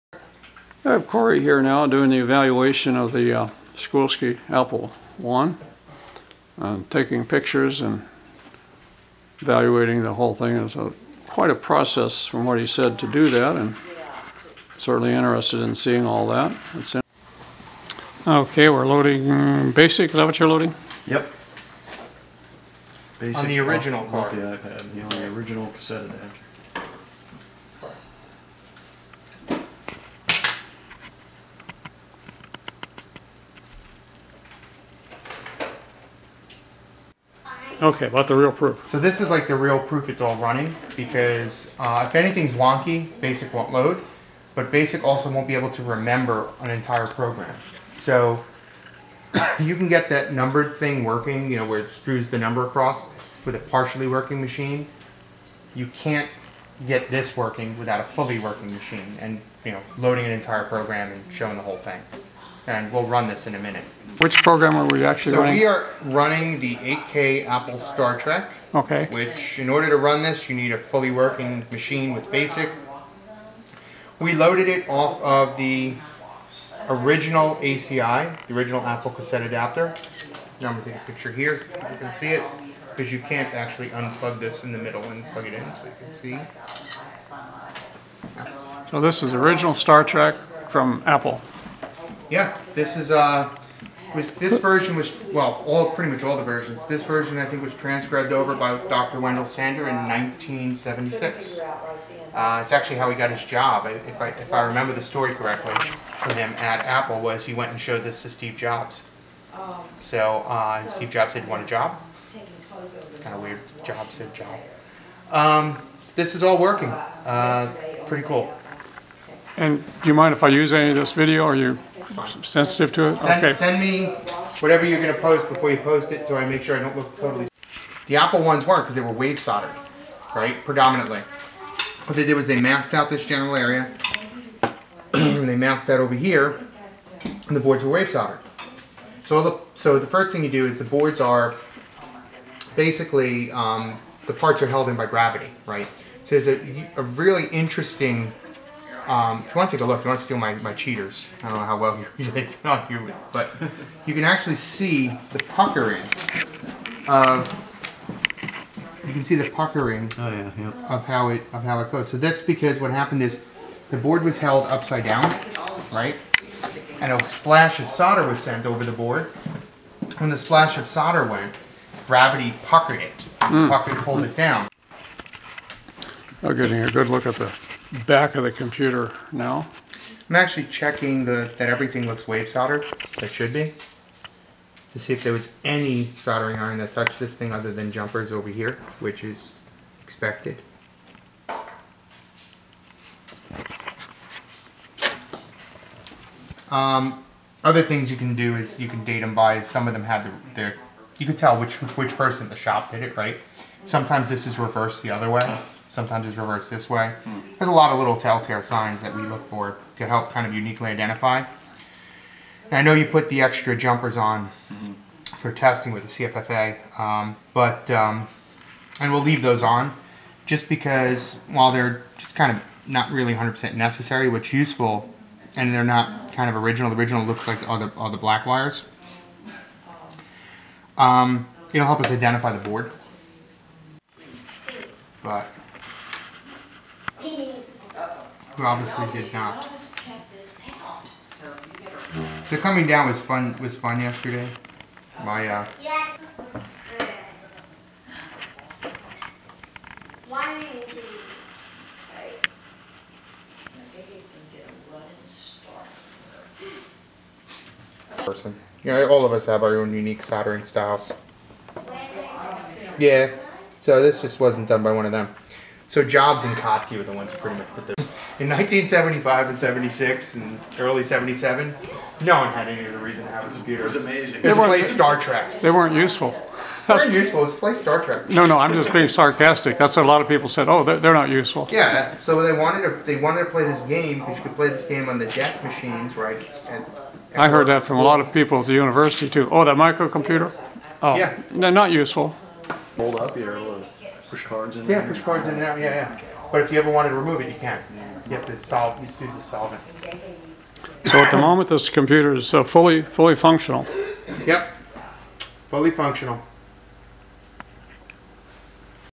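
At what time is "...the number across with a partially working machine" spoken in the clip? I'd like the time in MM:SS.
00:52.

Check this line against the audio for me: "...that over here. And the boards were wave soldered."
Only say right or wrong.
right.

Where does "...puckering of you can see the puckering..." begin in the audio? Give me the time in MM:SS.
02:35.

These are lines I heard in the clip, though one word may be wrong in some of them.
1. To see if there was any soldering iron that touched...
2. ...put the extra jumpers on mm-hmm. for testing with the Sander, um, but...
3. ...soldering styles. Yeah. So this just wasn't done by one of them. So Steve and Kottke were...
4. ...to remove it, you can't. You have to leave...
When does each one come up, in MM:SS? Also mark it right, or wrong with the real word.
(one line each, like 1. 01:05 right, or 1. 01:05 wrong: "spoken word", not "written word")
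1. 03:04 right
2. 03:33 wrong: "CFFA", not "Sander"
3. 04:20 wrong: "Jobs", not "Steve"
4. 04:57 wrong: "solve", not "leave".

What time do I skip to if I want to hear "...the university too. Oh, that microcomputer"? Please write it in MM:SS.
04:48.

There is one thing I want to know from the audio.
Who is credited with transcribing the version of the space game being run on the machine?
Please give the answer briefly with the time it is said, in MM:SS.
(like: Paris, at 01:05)
Dr. Wendell Sander, at 01:38.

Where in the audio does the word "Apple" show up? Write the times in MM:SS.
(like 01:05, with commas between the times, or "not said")
00:04, 01:07, 01:18, 01:31, 01:46, 02:08.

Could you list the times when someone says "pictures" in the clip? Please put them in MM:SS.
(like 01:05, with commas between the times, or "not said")
00:07, 01:21.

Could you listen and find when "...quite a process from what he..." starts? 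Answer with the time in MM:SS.
00:11.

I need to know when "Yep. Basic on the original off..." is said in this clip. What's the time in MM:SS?
00:21.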